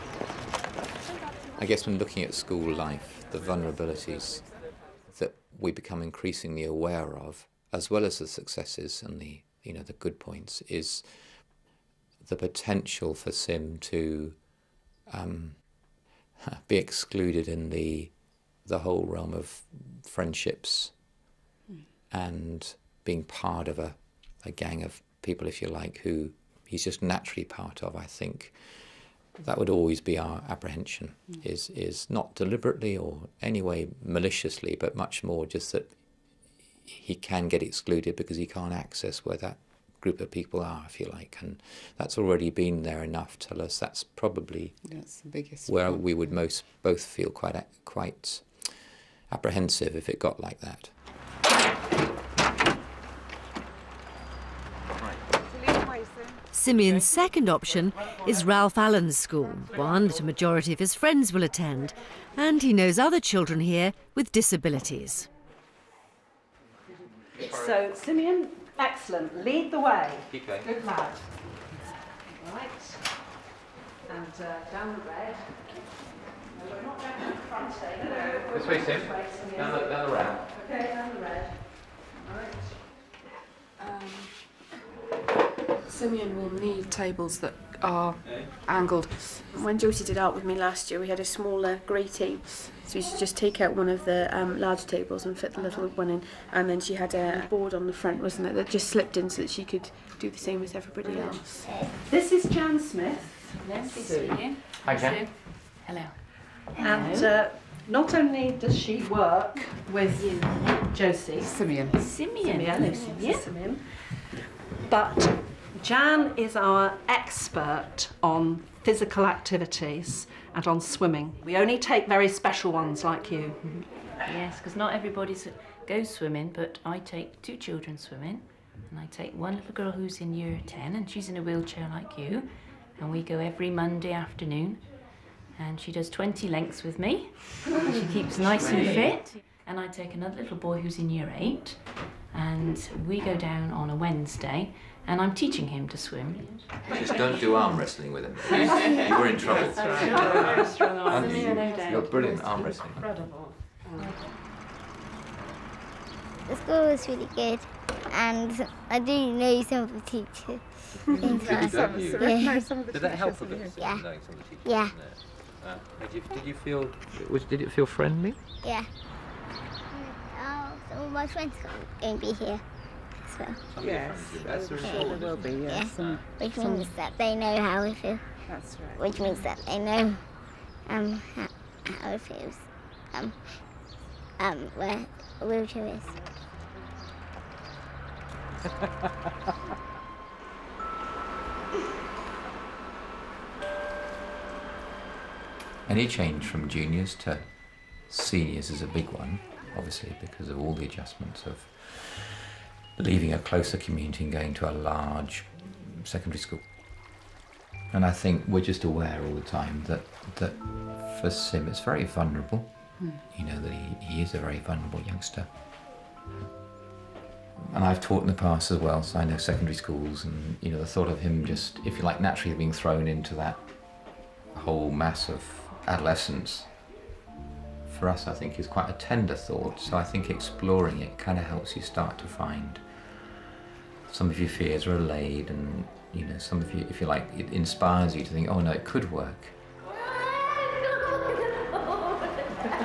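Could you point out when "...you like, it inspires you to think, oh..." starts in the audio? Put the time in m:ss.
3:57.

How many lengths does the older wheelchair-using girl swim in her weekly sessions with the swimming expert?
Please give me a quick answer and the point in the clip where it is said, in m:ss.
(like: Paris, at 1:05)
20, at 2:16.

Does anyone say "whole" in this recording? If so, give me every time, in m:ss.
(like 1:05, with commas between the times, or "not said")
0:18, 3:44.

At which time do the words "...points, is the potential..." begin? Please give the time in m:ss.
0:10.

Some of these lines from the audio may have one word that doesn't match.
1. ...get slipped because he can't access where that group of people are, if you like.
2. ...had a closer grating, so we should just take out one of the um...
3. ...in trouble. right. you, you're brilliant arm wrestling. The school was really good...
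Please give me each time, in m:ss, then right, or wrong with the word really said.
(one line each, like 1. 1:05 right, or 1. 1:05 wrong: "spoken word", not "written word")
1. 0:37 wrong: "excluded", not "slipped"
2. 1:31 wrong: "smaller", not "closer"
3. 2:29 right.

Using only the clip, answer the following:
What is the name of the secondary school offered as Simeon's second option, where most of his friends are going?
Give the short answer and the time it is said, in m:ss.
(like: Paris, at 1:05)
Ralph Allen's school, at 0:58.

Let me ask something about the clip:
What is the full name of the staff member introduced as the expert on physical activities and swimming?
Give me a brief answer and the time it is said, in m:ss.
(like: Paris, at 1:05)
Jan Smith, at 1:42.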